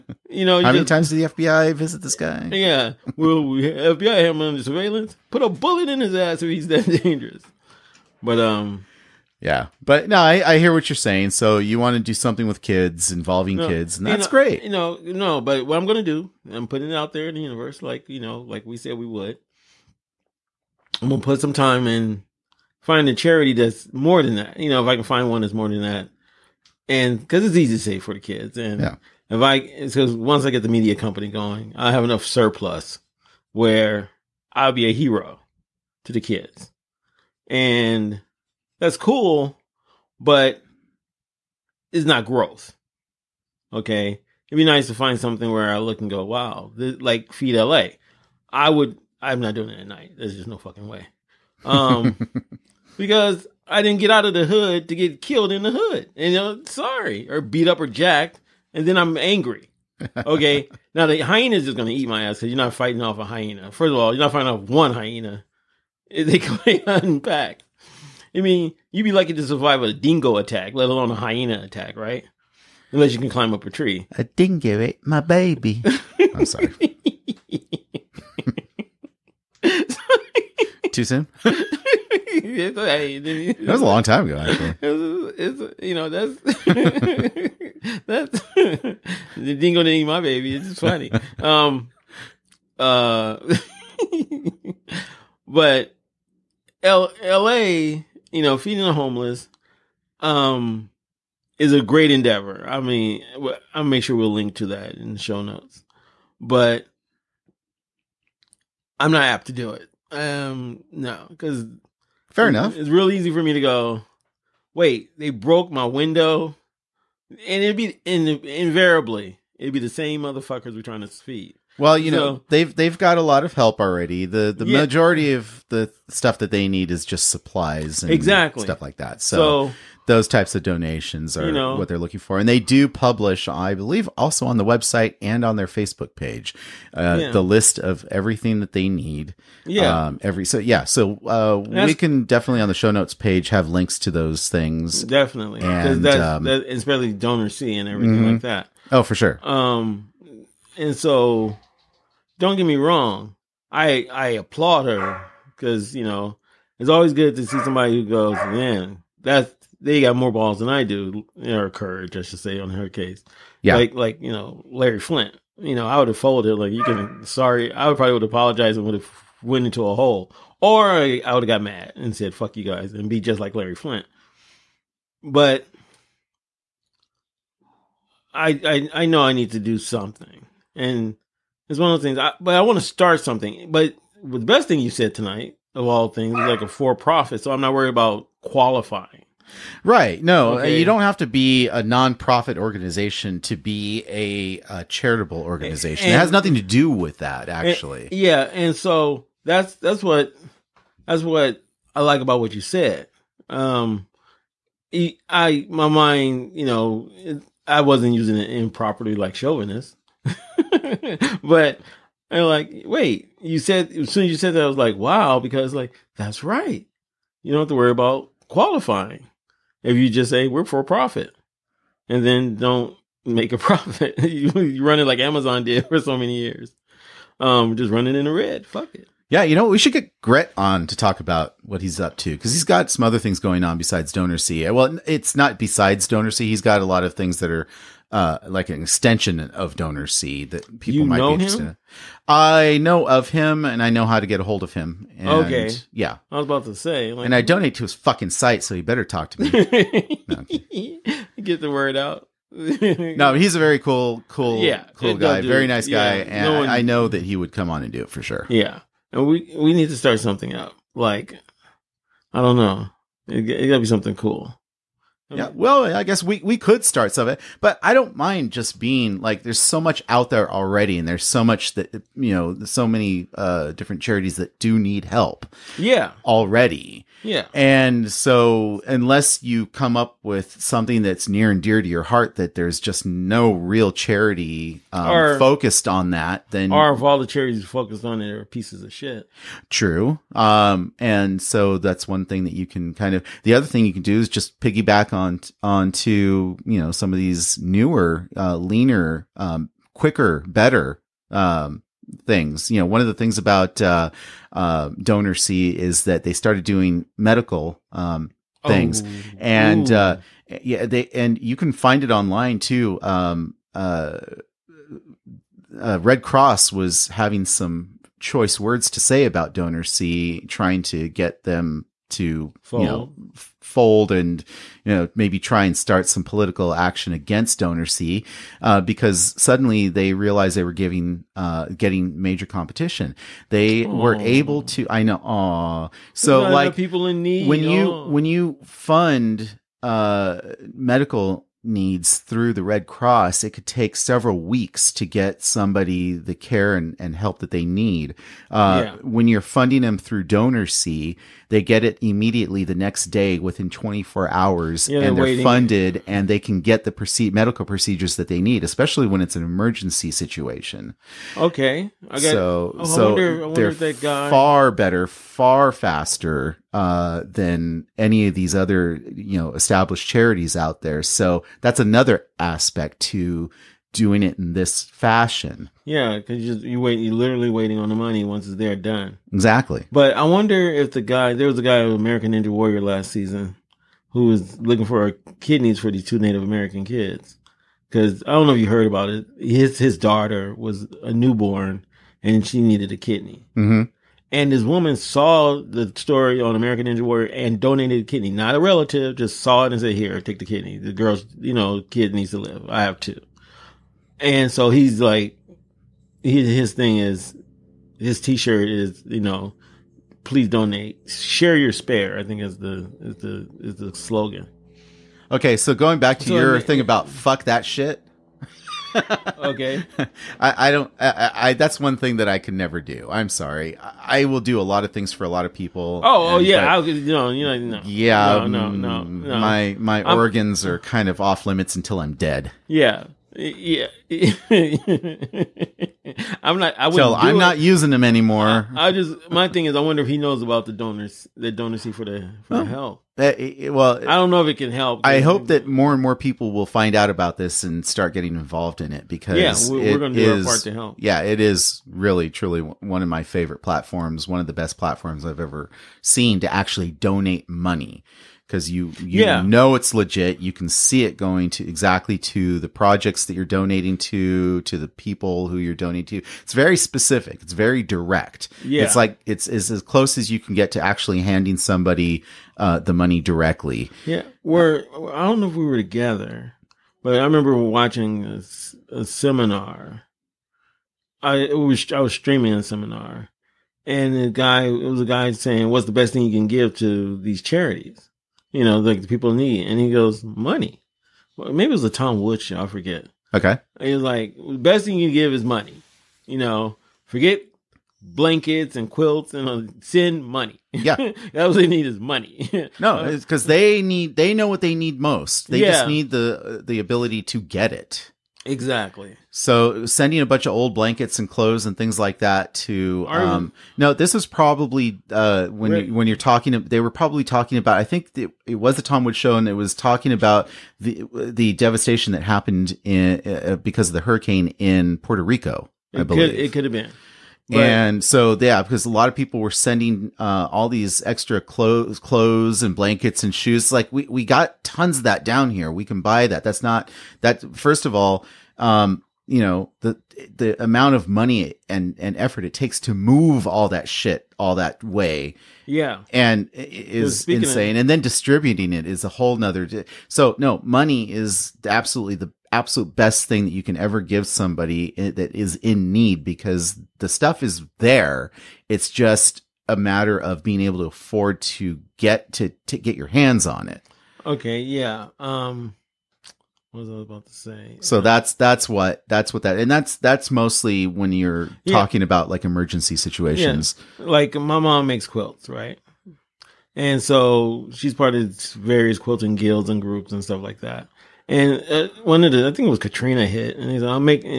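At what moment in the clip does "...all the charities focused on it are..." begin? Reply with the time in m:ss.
4:47.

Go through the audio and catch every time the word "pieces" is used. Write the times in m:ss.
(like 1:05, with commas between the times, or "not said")
4:48.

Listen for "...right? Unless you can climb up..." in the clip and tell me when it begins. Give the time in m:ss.
1:11.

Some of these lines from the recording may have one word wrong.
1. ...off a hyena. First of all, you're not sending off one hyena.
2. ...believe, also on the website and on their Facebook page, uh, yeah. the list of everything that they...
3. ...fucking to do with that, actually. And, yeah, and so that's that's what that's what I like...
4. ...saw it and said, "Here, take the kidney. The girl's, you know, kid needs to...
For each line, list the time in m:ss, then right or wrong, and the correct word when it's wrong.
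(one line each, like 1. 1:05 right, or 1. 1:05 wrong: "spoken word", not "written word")
1. 1:02 wrong: "fighting", not "sending"
2. 2:13 right
3. 3:16 wrong: "nothing", not "fucking"
4. 6:39 right.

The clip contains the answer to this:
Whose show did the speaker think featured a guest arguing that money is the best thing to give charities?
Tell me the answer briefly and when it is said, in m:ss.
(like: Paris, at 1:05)
Tom Woods, at 8:11.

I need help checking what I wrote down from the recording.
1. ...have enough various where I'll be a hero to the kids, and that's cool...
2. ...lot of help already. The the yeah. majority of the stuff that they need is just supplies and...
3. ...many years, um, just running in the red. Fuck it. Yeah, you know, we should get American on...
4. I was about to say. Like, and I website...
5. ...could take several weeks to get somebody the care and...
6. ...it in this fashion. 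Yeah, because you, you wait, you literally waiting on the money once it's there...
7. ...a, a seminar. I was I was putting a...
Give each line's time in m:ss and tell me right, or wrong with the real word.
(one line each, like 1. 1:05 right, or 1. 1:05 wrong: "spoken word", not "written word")
1. 0:31 wrong: "surplus", not "various"
2. 2:03 right
3. 3:46 wrong: "Gret", not "American"
4. 4:06 wrong: "donate", not "website"
5. 5:43 right
6. 6:14 right
7. 7:58 wrong: "streaming", not "putting".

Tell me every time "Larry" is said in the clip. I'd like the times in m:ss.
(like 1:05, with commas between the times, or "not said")
2:44, 2:53.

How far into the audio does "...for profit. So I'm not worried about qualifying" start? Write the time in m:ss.
3:06.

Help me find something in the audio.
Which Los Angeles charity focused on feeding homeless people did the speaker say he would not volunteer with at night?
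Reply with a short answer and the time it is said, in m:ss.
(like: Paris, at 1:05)
Feed LA, at 0:47.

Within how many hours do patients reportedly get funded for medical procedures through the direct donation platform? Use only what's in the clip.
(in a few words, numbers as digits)
24.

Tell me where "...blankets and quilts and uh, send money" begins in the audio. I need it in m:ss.
8:17.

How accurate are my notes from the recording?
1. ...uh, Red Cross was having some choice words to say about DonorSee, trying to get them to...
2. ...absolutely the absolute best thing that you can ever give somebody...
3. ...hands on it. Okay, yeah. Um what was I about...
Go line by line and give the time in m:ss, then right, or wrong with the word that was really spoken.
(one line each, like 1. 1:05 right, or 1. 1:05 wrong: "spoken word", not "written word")
1. 5:15 right
2. 9:11 right
3. 9:23 right.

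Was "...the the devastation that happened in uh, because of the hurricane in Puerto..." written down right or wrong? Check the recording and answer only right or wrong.
right.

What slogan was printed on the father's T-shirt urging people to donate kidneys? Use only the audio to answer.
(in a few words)
Share your spare.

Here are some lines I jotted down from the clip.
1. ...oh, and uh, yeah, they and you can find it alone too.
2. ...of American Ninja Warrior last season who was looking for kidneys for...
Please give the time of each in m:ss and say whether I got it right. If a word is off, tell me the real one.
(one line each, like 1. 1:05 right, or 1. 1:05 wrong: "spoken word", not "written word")
1. 5:09 wrong: "online", not "alone"
2. 6:21 right.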